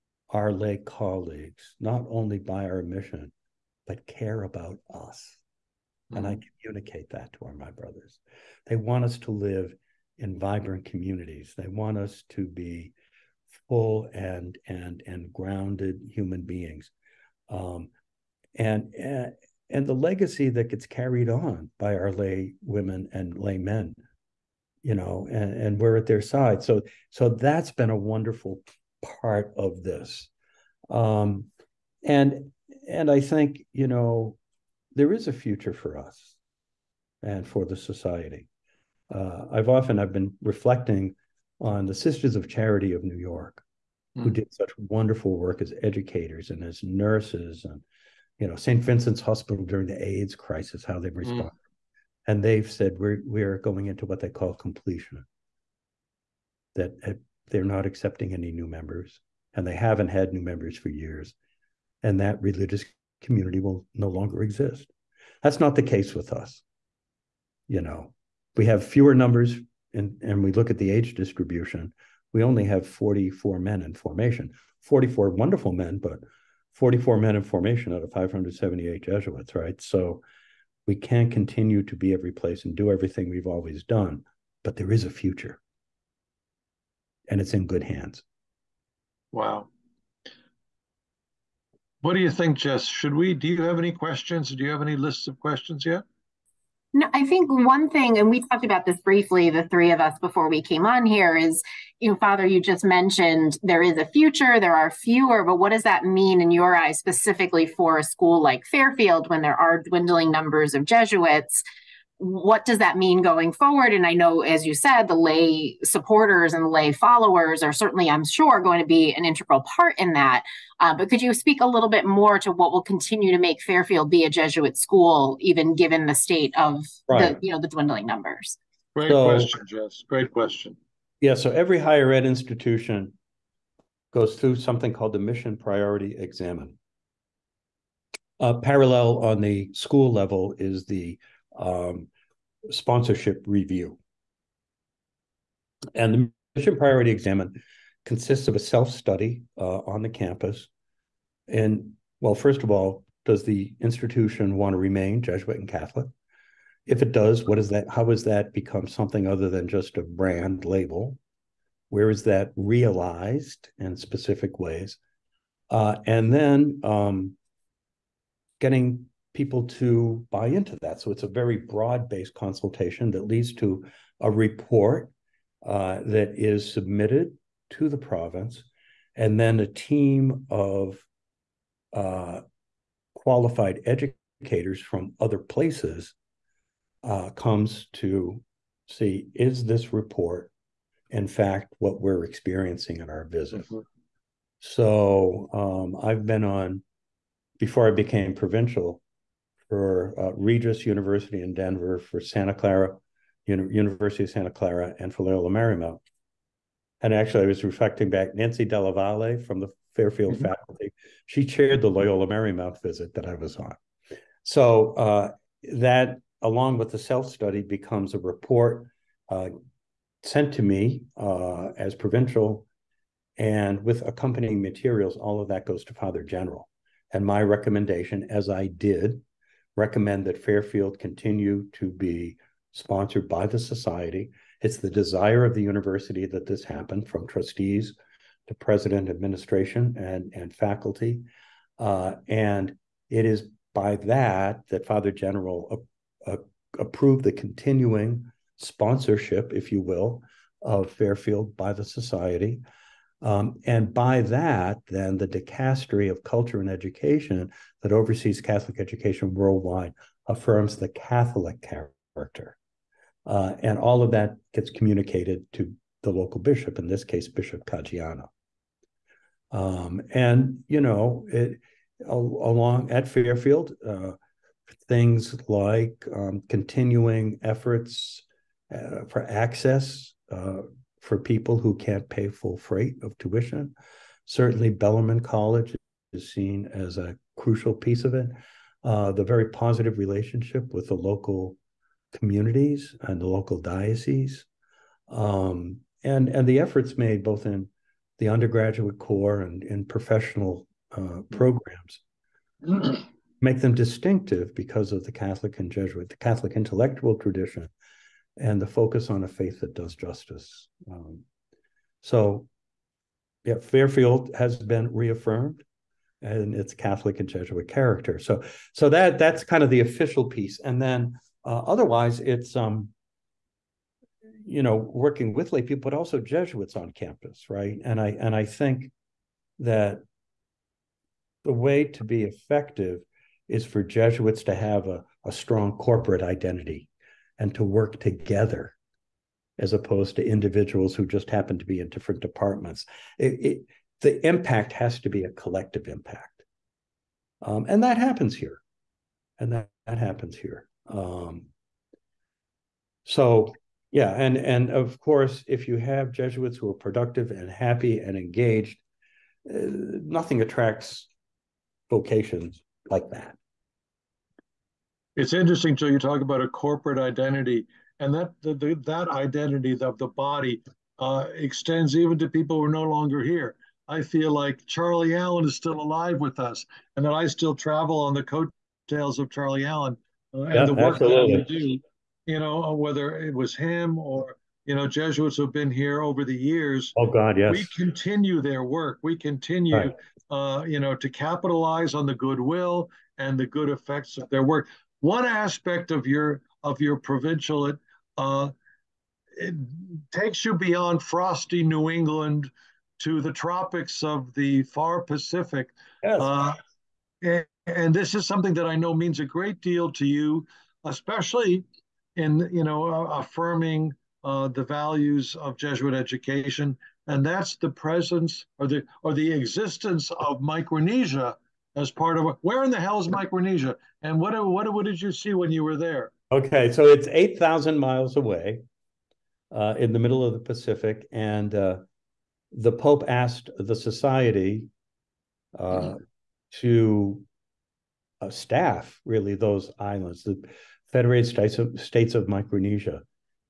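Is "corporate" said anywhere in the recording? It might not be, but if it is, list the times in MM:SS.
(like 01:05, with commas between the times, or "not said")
05:35, 06:06.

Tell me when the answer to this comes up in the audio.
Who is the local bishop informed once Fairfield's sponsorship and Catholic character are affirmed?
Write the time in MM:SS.
04:27.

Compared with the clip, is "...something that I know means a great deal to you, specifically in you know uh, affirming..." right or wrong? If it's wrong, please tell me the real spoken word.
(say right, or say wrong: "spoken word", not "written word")
wrong: "especially", not "specifically".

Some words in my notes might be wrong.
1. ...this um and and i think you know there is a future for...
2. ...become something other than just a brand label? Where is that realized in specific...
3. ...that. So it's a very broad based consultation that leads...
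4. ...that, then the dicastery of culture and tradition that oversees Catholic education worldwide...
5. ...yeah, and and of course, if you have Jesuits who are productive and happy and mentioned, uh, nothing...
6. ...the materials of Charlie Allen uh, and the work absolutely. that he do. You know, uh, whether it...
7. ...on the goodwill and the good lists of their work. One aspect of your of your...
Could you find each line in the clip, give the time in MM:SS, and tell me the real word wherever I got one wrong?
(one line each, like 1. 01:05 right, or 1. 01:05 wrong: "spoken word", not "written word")
1. 00:29 right
2. 02:38 right
3. 02:50 right
4. 04:14 wrong: "education", not "tradition"
5. 05:53 wrong: "engaged", not "mentioned"
6. 06:18 wrong: "coattails", not "materials"
7. 06:31 wrong: "effects", not "lists".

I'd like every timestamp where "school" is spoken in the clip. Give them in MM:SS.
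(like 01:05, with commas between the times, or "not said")
01:48, 02:04, 02:19.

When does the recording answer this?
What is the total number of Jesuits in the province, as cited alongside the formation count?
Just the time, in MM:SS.
01:18.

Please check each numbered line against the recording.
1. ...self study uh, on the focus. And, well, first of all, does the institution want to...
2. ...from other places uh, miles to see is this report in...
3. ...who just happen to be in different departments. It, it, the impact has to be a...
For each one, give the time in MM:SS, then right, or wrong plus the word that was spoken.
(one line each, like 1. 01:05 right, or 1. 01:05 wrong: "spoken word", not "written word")
1. 02:28 wrong: "campus", not "focus"
2. 03:04 wrong: "comes", not "miles"
3. 05:40 right.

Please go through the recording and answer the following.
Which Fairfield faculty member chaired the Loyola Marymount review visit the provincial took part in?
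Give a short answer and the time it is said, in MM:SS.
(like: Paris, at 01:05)
Nancy Dallavalle, at 03:28.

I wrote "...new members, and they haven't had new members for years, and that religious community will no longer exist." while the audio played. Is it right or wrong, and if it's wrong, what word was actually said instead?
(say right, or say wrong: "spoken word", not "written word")
right.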